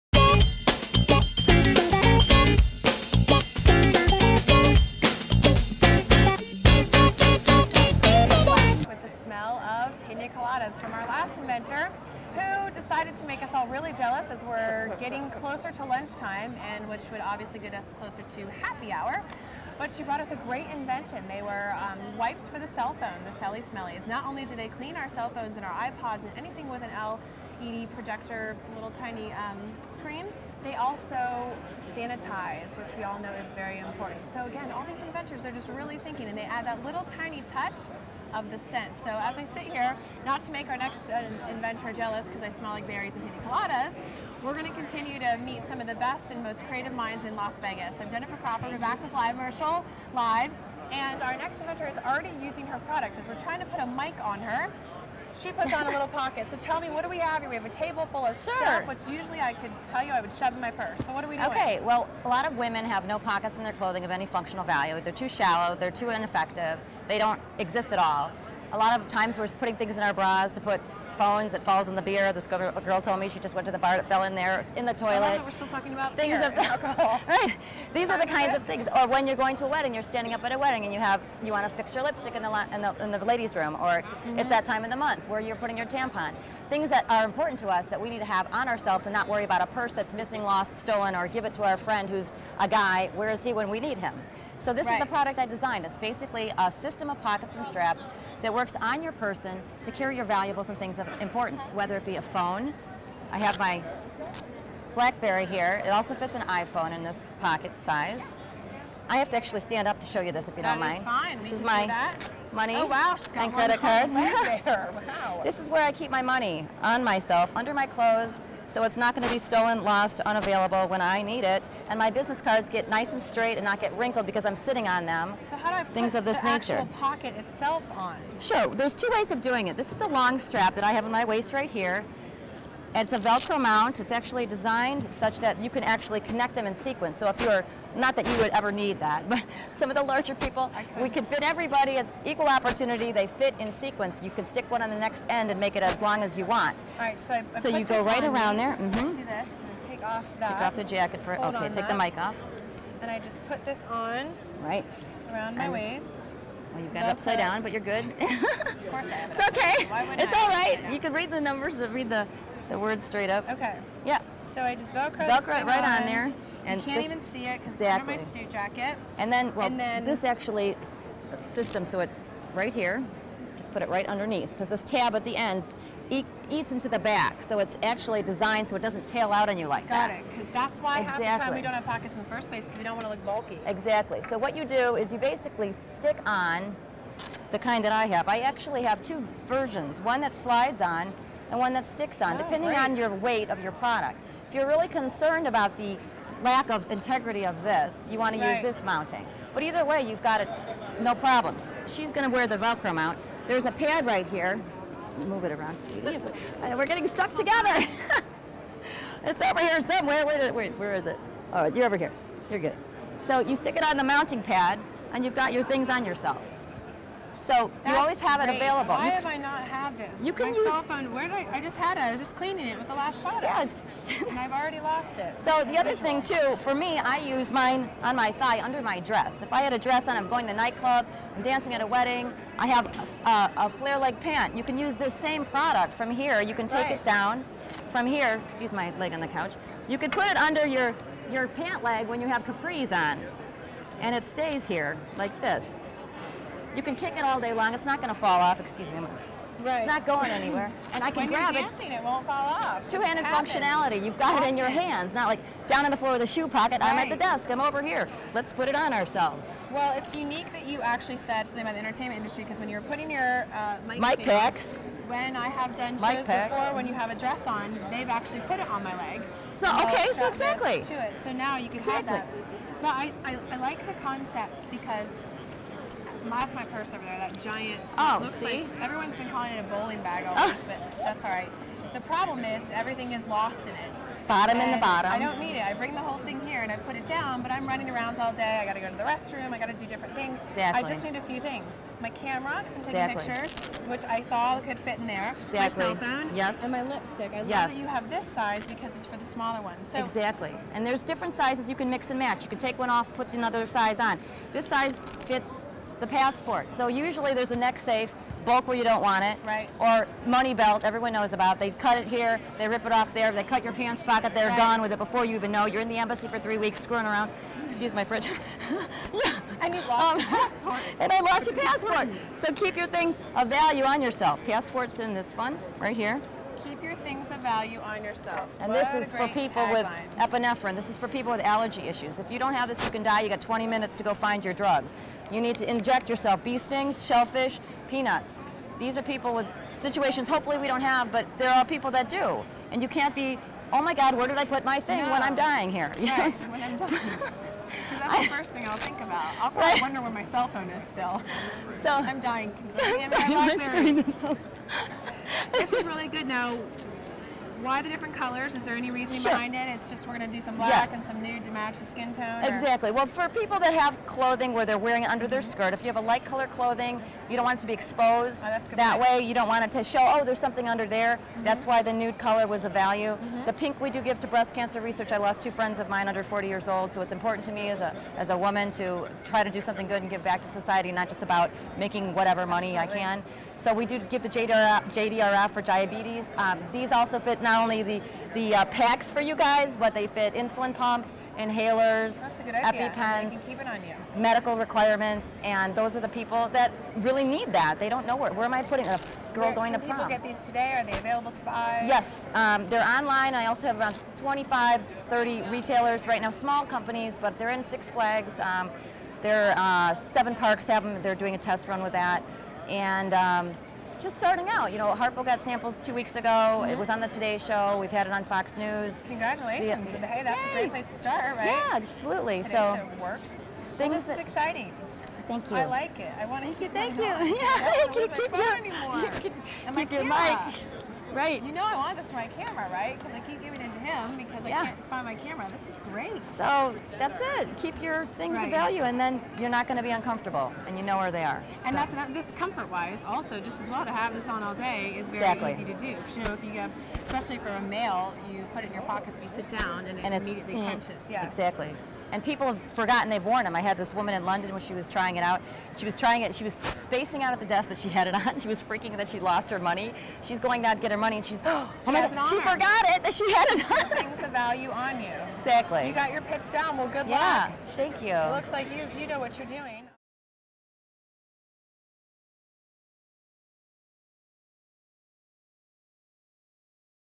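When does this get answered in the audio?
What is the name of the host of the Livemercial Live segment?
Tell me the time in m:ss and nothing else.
0:48.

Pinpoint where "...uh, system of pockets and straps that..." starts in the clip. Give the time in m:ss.
1:36.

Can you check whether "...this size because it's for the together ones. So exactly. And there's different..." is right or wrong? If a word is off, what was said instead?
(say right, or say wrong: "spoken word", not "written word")
wrong: "smaller", not "together".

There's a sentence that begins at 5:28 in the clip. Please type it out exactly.
And what this is for people with epinephrine.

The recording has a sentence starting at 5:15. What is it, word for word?
You're in the embassy for three weeks screwing around.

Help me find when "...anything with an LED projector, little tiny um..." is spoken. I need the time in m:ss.
0:26.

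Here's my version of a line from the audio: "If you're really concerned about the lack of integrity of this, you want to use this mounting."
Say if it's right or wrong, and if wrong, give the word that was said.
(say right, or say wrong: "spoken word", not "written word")
right.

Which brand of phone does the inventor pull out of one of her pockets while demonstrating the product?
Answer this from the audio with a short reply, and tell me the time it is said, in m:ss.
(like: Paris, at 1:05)
BlackBerry, at 1:44.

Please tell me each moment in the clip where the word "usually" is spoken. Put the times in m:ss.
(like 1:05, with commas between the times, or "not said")
0:59, 5:06.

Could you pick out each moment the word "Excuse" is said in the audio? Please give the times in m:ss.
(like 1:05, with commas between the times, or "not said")
3:58, 4:08, 5:17.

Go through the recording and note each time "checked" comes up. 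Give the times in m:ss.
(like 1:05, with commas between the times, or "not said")
not said.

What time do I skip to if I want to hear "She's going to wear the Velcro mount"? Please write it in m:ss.
3:21.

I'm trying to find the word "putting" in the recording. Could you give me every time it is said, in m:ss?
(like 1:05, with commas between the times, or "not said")
1:09, 1:25, 4:22, 6:38.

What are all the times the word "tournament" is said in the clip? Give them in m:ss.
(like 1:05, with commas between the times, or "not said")
not said.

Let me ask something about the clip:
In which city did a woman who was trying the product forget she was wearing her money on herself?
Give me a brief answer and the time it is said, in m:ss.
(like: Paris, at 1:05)
London, at 7:34.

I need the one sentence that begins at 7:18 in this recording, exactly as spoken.
of value, and then you're not going to be uncomfortable, and you know where they are.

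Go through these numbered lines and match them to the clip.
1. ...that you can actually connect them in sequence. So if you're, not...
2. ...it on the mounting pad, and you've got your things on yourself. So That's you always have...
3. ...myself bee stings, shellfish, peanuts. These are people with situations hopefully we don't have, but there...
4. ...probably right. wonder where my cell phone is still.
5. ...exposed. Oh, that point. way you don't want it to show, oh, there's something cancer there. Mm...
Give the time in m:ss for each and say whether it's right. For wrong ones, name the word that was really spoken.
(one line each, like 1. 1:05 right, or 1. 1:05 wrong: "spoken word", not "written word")
1. 2:15 right
2. 3:33 right
3. 5:36 wrong: "yourself", not "myself"
4. 5:49 right
5. 6:07 wrong: "under", not "cancer".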